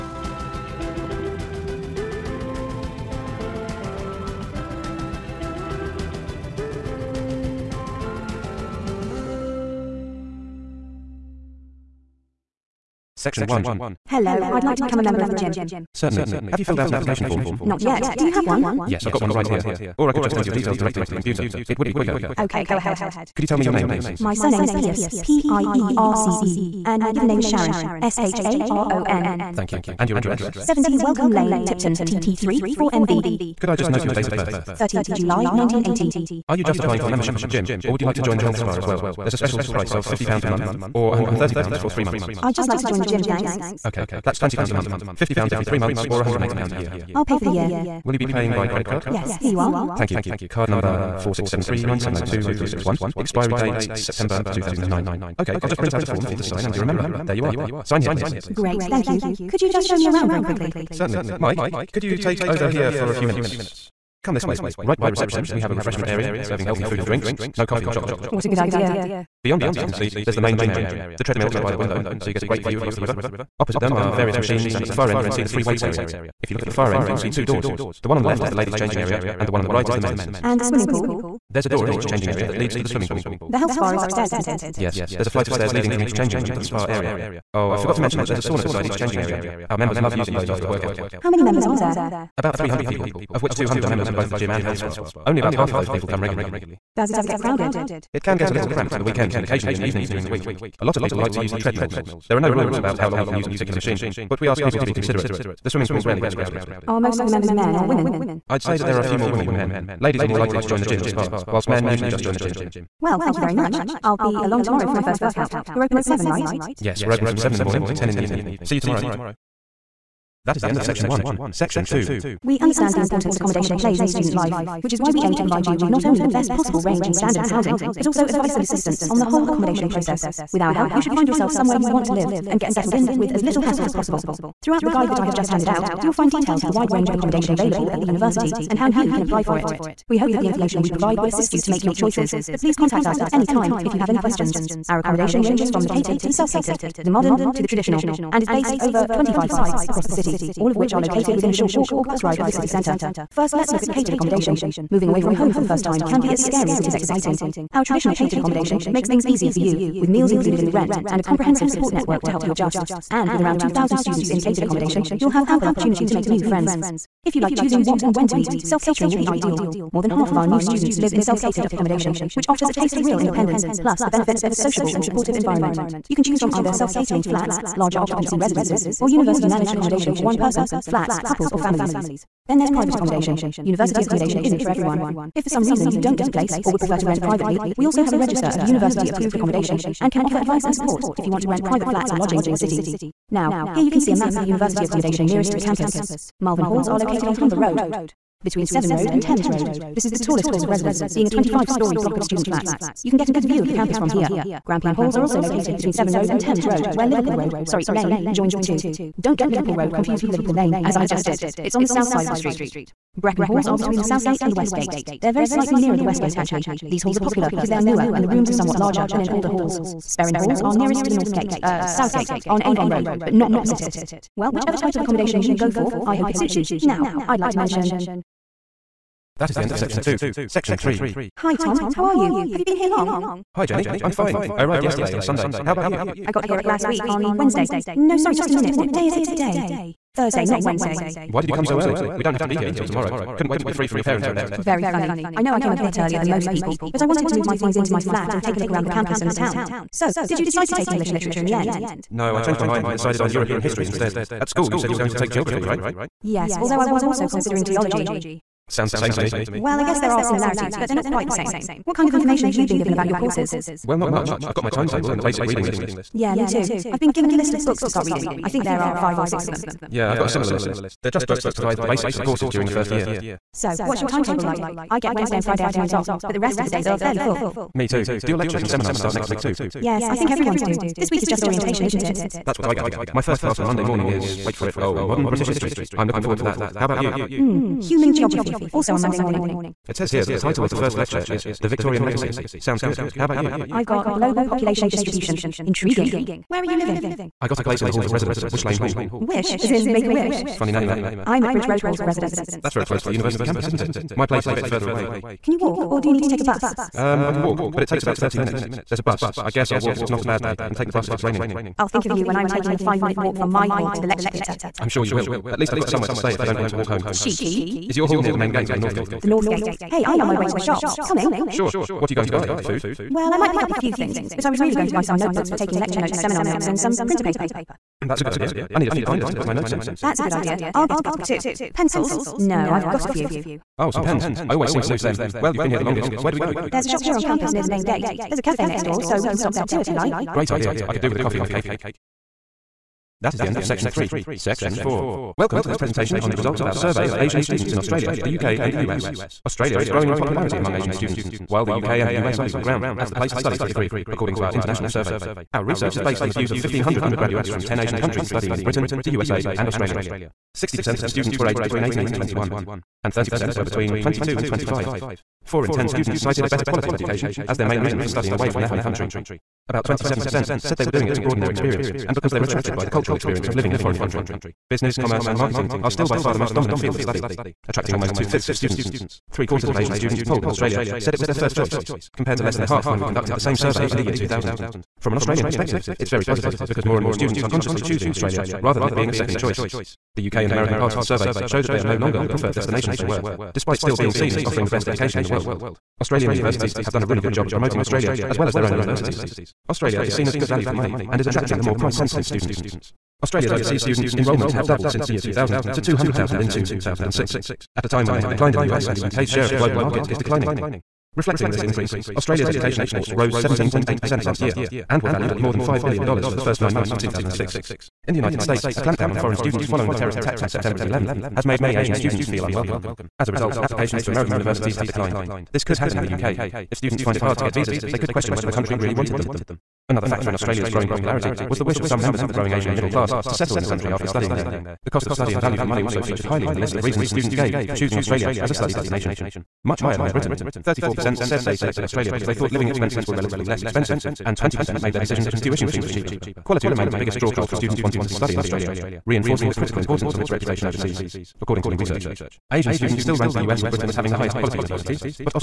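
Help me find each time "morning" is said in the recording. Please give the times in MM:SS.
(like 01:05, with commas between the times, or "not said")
01:57, 04:43, 04:49.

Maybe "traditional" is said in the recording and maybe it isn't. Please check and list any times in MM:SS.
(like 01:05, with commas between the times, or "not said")
02:27, 02:37.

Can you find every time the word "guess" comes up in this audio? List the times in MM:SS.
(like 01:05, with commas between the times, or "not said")
04:19, 05:09.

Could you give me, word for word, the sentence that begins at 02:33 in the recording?
First, let's look at catered accommodation.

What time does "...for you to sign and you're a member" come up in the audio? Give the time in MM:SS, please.
00:56.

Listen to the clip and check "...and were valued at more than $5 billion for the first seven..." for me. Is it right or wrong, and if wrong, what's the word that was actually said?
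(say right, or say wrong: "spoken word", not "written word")
wrong: "nine", not "seven".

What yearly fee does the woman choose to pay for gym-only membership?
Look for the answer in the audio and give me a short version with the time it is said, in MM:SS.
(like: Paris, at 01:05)
£180, at 00:46.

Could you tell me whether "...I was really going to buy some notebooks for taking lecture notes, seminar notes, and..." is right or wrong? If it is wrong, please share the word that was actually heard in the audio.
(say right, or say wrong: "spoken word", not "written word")
right.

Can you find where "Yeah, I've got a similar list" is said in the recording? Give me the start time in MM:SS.
04:29.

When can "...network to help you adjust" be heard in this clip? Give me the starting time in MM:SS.
02:41.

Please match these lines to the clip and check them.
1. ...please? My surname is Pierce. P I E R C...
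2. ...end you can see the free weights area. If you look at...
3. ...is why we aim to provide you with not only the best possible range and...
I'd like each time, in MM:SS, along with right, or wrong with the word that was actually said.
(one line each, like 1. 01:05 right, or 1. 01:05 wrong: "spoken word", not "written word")
1. 00:23 right
2. 01:15 right
3. 02:04 right.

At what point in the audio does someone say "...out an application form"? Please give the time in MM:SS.
00:16.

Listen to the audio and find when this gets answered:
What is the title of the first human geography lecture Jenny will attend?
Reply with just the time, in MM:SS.
04:54.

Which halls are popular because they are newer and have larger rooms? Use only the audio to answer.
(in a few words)
Brecon Halls.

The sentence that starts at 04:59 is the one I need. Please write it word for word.
Wish, as in make a wish?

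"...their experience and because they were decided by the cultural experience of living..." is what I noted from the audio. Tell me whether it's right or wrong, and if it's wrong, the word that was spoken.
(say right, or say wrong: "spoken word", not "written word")
wrong: "attracted", not "decided".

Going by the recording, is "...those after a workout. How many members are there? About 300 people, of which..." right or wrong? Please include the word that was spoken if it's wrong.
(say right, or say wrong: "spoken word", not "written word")
right.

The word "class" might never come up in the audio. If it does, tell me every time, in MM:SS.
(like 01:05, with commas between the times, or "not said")
04:43, 07:12.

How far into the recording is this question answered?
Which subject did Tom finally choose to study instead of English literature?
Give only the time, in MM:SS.
04:13.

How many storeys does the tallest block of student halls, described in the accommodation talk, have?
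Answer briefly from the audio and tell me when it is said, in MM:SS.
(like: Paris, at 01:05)
25, at 03:21.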